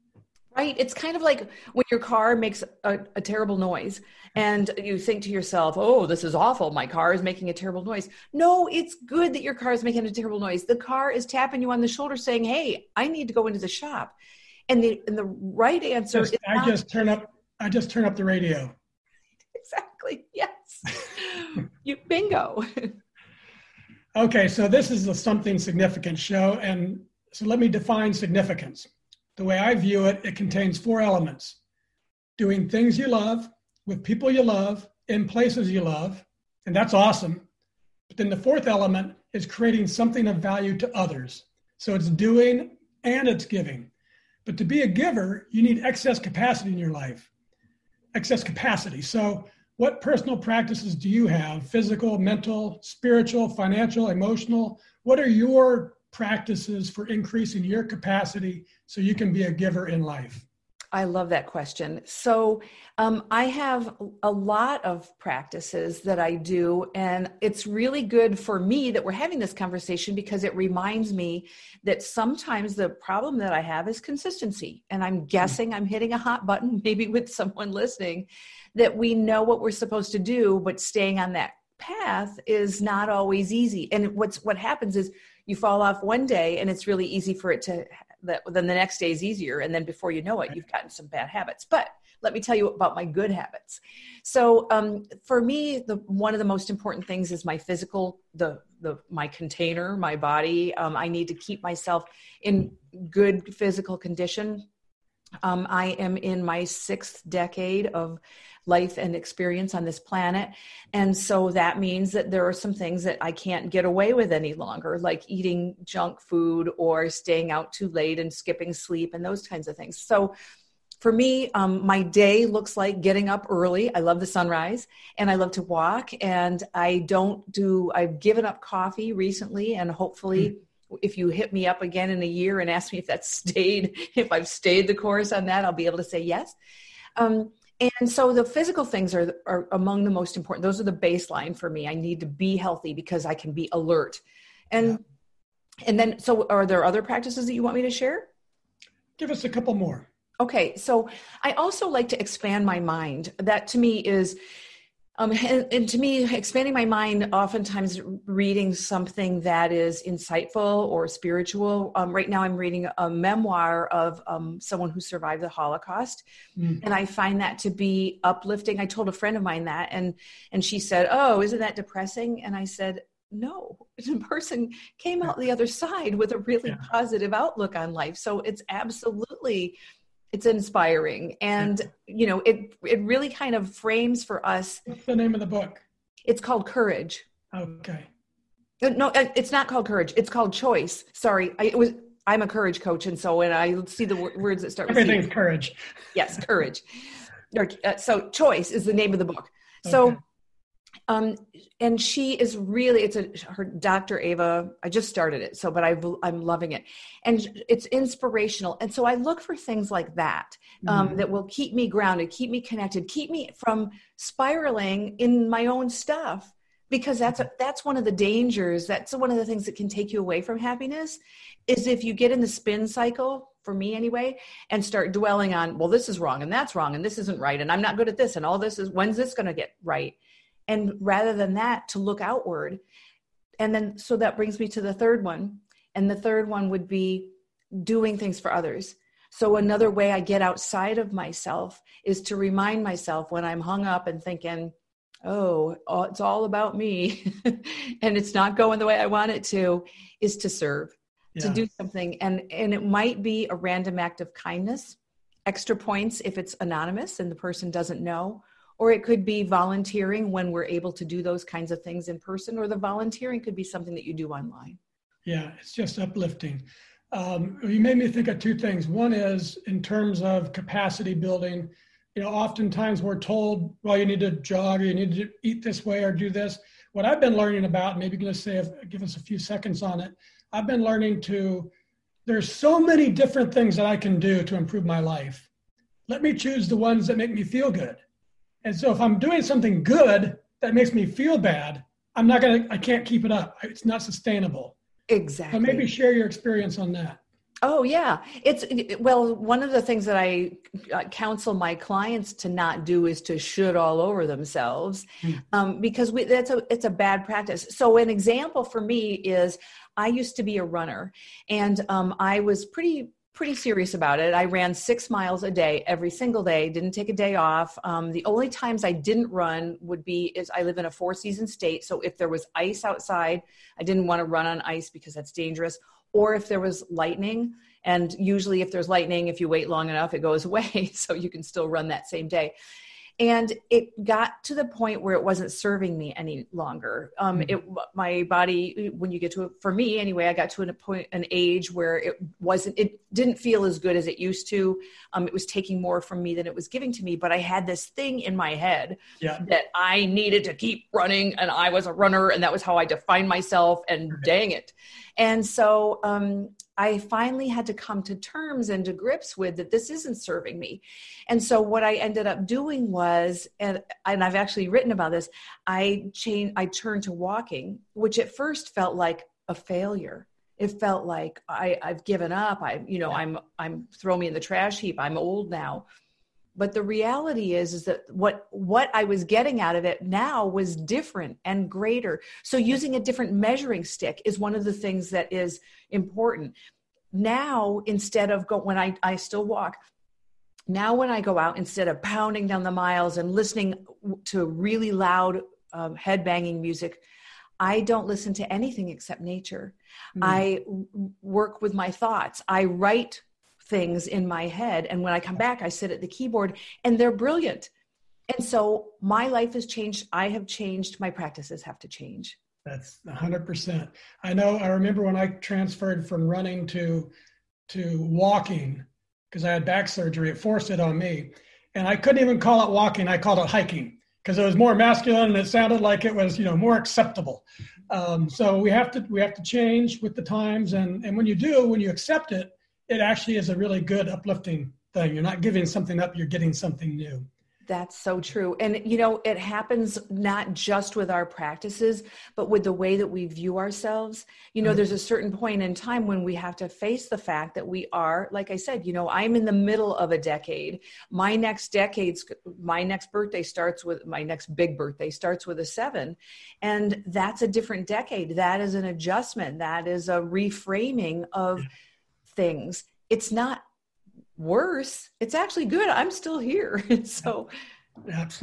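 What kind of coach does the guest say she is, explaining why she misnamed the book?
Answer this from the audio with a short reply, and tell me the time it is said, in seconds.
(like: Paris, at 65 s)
Courage coach, at 192 s.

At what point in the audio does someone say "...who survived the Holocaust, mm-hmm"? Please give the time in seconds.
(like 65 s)
164 s.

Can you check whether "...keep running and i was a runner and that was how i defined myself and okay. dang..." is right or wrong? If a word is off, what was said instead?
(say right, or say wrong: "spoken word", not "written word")
right.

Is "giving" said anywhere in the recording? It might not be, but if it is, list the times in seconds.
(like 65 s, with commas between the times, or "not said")
43 s, 346 s, 435 s.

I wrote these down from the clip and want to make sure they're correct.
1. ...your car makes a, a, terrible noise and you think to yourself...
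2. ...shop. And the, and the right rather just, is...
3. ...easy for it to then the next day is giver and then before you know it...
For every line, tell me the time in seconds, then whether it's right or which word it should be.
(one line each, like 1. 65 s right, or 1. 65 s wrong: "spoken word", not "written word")
1. 1 s right
2. 13 s wrong: "answer", not "rather"
3. 87 s wrong: "easier", not "giver".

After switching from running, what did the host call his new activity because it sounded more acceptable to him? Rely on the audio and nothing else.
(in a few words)
Hiking.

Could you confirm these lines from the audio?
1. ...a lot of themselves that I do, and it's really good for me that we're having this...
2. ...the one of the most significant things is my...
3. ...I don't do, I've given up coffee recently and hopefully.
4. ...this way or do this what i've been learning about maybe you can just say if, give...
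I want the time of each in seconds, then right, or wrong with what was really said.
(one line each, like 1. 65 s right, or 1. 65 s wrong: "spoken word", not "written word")
1. 64 s wrong: "practices", not "themselves"
2. 95 s wrong: "important", not "significant"
3. 126 s right
4. 275 s right.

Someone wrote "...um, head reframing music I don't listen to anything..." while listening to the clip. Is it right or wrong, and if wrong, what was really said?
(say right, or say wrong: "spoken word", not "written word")
wrong: "banging", not "reframing".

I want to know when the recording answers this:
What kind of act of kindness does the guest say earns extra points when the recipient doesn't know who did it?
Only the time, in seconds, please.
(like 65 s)
253 s.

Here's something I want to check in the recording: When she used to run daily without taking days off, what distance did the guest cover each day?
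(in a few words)
6 miles.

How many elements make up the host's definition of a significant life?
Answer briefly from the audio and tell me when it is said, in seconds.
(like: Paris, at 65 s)
4, at 30 s.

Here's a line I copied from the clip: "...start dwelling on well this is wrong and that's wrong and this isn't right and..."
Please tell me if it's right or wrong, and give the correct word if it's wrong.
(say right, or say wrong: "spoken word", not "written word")
right.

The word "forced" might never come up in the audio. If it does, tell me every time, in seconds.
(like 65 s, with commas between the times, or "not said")
420 s.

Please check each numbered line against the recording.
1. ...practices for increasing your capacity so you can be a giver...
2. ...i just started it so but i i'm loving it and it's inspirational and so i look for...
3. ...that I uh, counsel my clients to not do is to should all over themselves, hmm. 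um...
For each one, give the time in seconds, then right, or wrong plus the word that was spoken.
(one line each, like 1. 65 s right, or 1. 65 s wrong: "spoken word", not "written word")
1. 56 s right
2. 204 s right
3. 300 s right.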